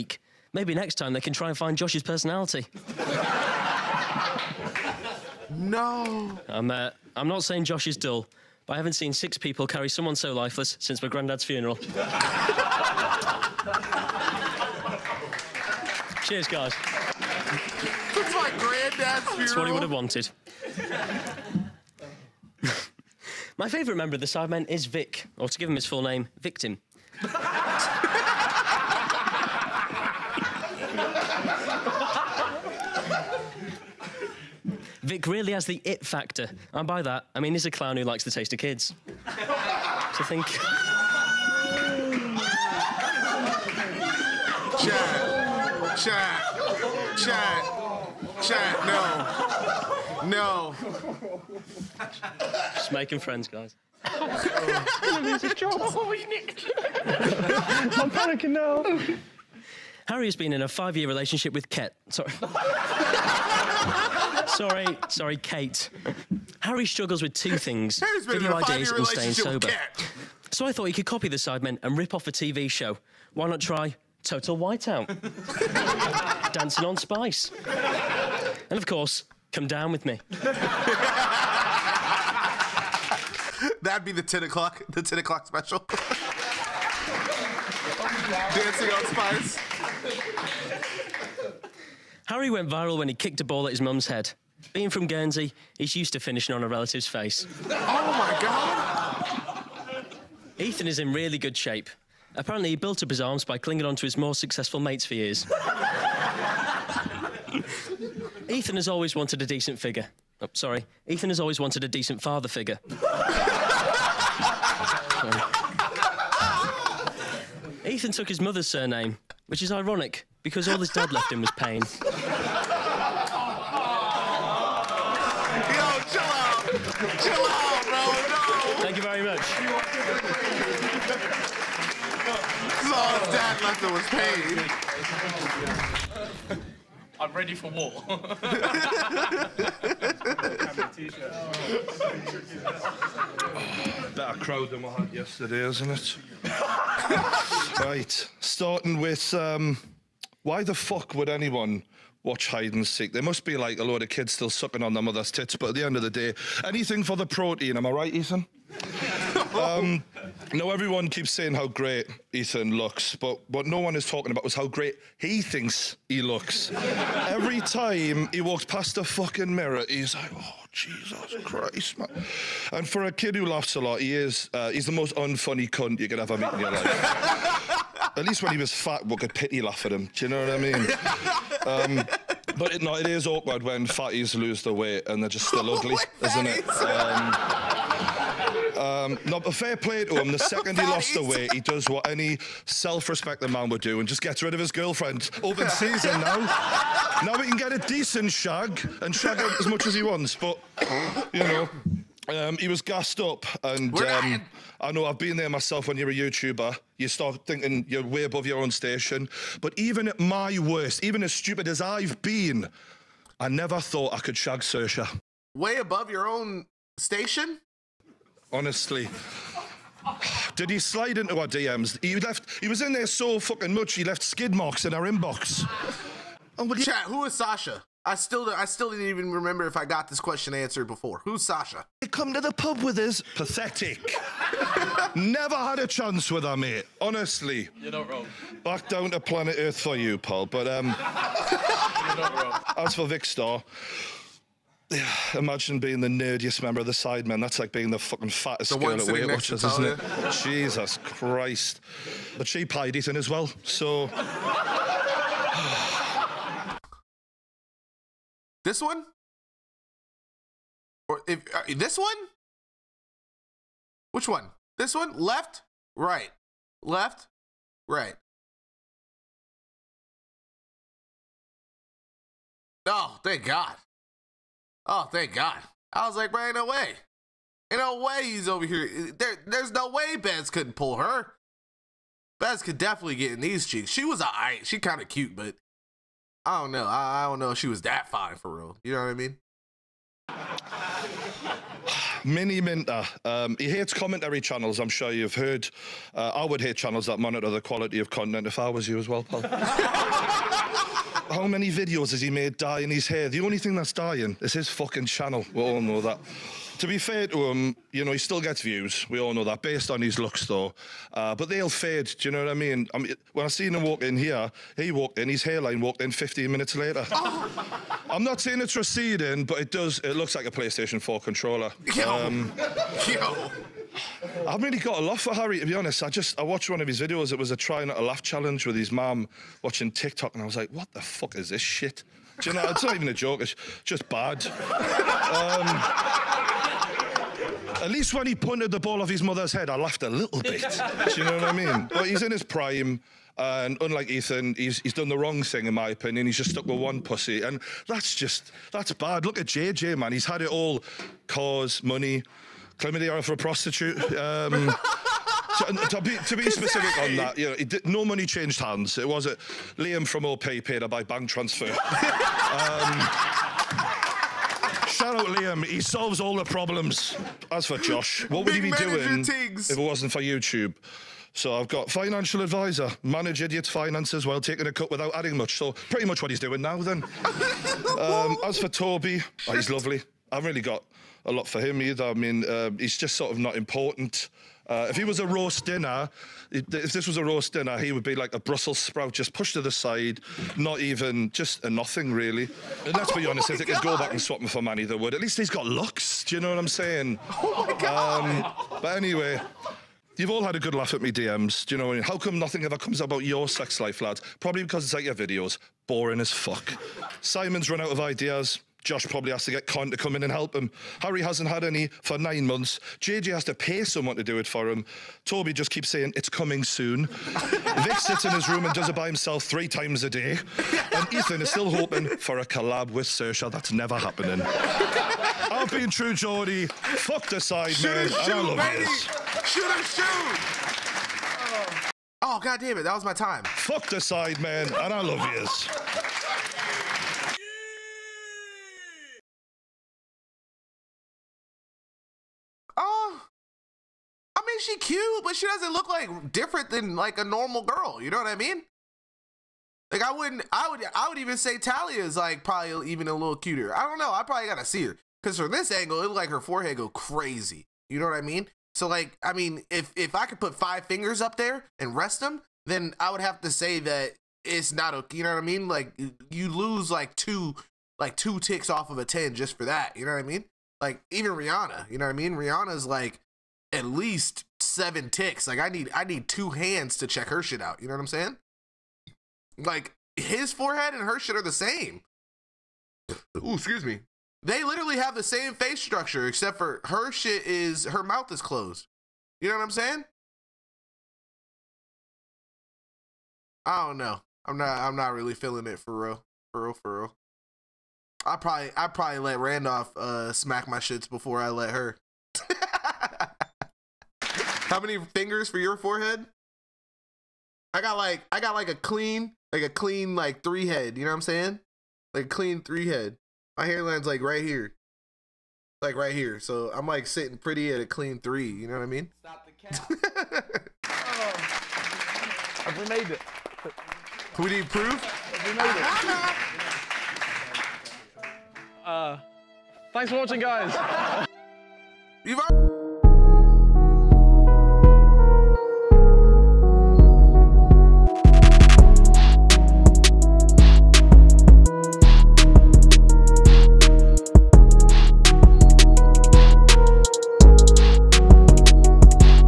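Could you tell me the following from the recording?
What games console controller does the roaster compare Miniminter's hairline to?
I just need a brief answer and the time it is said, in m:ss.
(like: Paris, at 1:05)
PlayStation 4, at 5:20.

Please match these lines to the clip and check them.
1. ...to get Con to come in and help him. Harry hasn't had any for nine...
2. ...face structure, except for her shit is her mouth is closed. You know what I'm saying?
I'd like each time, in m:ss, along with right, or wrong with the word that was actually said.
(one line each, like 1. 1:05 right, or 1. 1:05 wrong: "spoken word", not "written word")
1. 6:49 right
2. 8:05 right.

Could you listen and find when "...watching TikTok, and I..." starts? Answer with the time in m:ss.
5:29.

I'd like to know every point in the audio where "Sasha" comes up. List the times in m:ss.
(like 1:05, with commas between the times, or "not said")
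3:47, 3:51.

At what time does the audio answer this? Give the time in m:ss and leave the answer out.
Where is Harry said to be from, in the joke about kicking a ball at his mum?
1:35.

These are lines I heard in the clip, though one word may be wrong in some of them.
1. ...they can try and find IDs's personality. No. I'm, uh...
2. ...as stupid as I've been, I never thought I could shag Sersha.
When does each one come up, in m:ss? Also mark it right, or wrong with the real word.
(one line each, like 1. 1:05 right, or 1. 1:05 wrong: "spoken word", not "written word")
1. 0:01 wrong: "Josh", not "IDs"
2. 3:31 right.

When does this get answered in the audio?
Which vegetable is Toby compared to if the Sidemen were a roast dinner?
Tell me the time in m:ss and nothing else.
6:28.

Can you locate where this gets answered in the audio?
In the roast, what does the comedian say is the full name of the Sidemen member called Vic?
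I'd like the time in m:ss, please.
0:26.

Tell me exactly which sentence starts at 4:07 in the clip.
That's like being the fucking fattest the girl at Weight Watchers, isn't it?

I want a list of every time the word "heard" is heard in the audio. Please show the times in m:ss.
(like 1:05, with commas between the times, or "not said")
4:55.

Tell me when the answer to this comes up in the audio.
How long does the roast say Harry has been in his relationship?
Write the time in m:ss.
1:00.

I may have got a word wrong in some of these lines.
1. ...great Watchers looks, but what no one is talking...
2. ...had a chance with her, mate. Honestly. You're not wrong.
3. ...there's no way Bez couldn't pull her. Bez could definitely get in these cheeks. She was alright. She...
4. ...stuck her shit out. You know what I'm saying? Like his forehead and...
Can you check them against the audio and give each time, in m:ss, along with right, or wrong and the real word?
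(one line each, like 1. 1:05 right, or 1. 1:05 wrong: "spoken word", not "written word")
1. 2:41 wrong: "Ethan", not "Watchers"
2. 3:55 right
3. 4:39 right
4. 7:57 wrong: "check", not "stuck".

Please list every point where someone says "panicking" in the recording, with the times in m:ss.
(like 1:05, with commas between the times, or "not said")
0:58.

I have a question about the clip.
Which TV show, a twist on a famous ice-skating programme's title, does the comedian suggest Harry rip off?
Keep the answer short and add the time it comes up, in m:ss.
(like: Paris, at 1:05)
Total Whiteout, at 1:14.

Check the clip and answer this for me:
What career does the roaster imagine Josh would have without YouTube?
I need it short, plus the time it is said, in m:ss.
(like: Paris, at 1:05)
Financial advisor, at 6:11.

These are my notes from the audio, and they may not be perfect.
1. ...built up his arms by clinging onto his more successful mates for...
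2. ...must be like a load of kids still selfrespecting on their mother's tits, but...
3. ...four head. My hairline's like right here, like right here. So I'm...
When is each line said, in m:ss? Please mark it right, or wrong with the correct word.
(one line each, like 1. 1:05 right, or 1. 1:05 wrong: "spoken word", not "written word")
1. 1:42 right
2. 2:33 wrong: "sucking", not "selfrespecting"
3. 8:32 wrong: "three", not "four".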